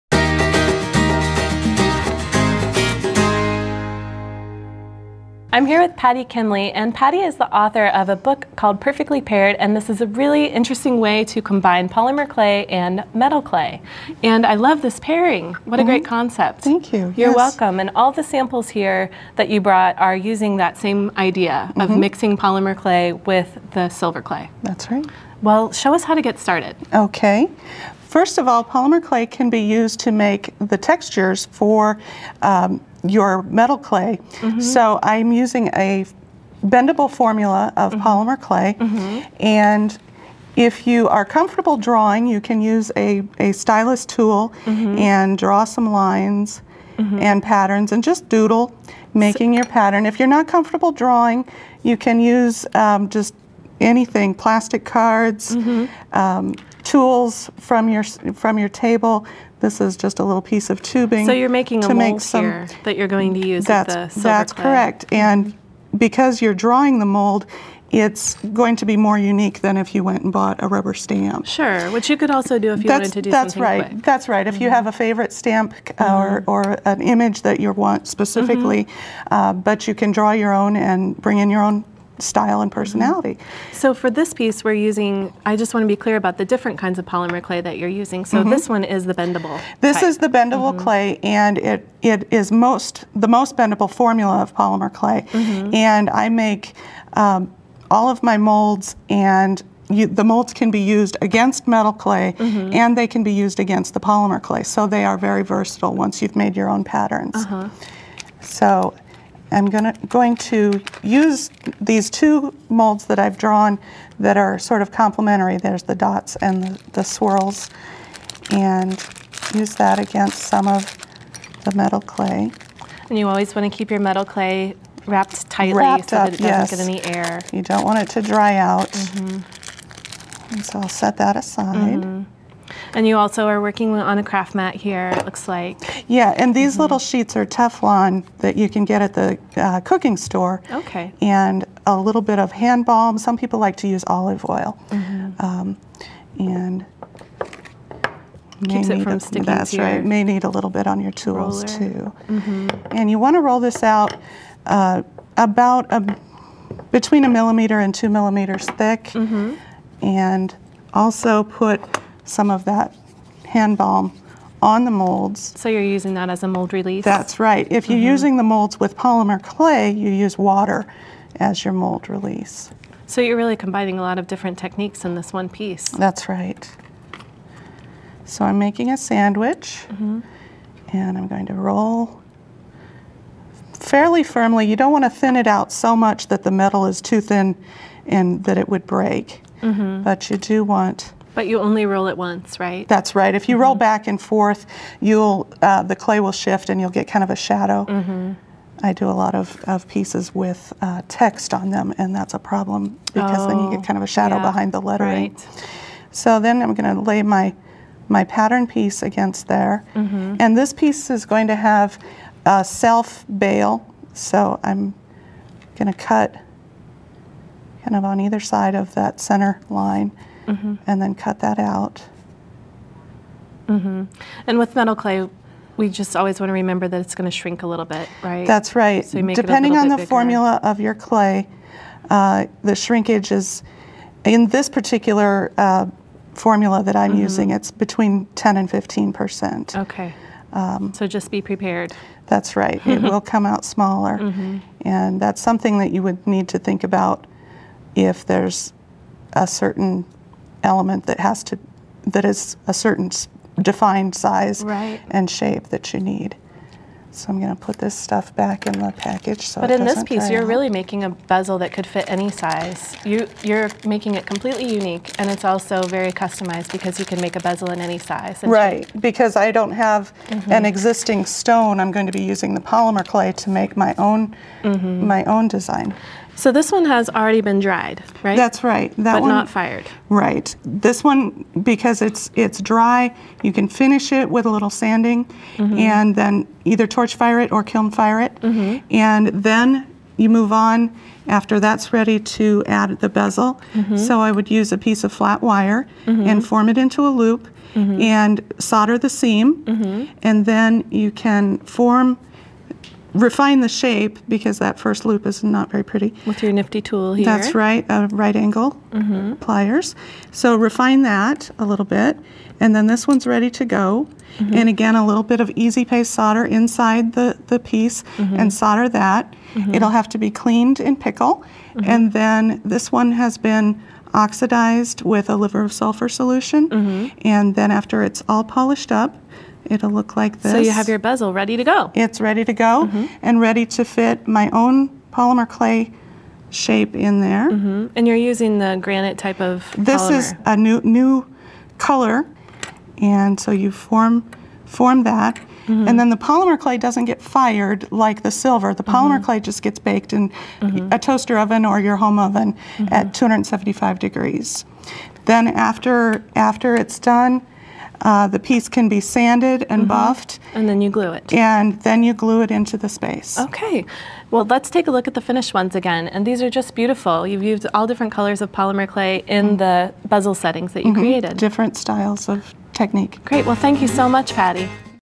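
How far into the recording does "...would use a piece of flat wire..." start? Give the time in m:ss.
4:54.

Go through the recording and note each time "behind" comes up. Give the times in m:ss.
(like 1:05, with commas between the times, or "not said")
3:24.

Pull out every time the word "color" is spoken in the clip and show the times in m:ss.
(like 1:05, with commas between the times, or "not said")
5:41, 6:08.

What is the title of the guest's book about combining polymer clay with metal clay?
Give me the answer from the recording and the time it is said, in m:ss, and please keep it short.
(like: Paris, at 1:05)
Perfectly Paired, at 0:08.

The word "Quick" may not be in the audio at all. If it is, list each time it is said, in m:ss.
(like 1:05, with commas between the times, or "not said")
1:13.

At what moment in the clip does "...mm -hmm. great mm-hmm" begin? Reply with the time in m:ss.
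0:15.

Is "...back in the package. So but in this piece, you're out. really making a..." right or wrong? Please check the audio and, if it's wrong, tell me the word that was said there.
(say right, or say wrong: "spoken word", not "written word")
right.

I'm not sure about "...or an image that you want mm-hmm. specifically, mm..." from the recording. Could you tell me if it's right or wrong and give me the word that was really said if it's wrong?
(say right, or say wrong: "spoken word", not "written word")
right.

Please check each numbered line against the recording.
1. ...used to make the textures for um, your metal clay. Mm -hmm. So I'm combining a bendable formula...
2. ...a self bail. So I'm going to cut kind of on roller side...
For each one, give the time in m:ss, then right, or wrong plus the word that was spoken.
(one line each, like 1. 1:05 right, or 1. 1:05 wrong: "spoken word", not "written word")
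1. 0:29 wrong: "using", not "combining"
2. 3:32 wrong: "either", not "roller".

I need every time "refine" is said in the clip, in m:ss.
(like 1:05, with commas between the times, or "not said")
5:03, 5:10.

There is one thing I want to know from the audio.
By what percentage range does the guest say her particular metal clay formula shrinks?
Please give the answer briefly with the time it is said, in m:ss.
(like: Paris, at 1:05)
10 to 15 percent, at 3:57.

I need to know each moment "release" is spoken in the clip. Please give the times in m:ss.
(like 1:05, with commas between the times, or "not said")
2:46, 2:52.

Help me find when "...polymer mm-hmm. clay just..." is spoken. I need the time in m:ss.
5:48.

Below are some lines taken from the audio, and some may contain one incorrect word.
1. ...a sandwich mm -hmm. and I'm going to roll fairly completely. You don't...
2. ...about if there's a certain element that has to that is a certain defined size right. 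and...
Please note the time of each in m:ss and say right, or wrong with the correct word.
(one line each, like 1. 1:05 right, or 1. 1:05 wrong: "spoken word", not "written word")
1. 2:58 wrong: "firmly", not "completely"
2. 4:06 right.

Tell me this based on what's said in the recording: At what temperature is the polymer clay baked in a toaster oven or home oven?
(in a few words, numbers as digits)
275 degrees.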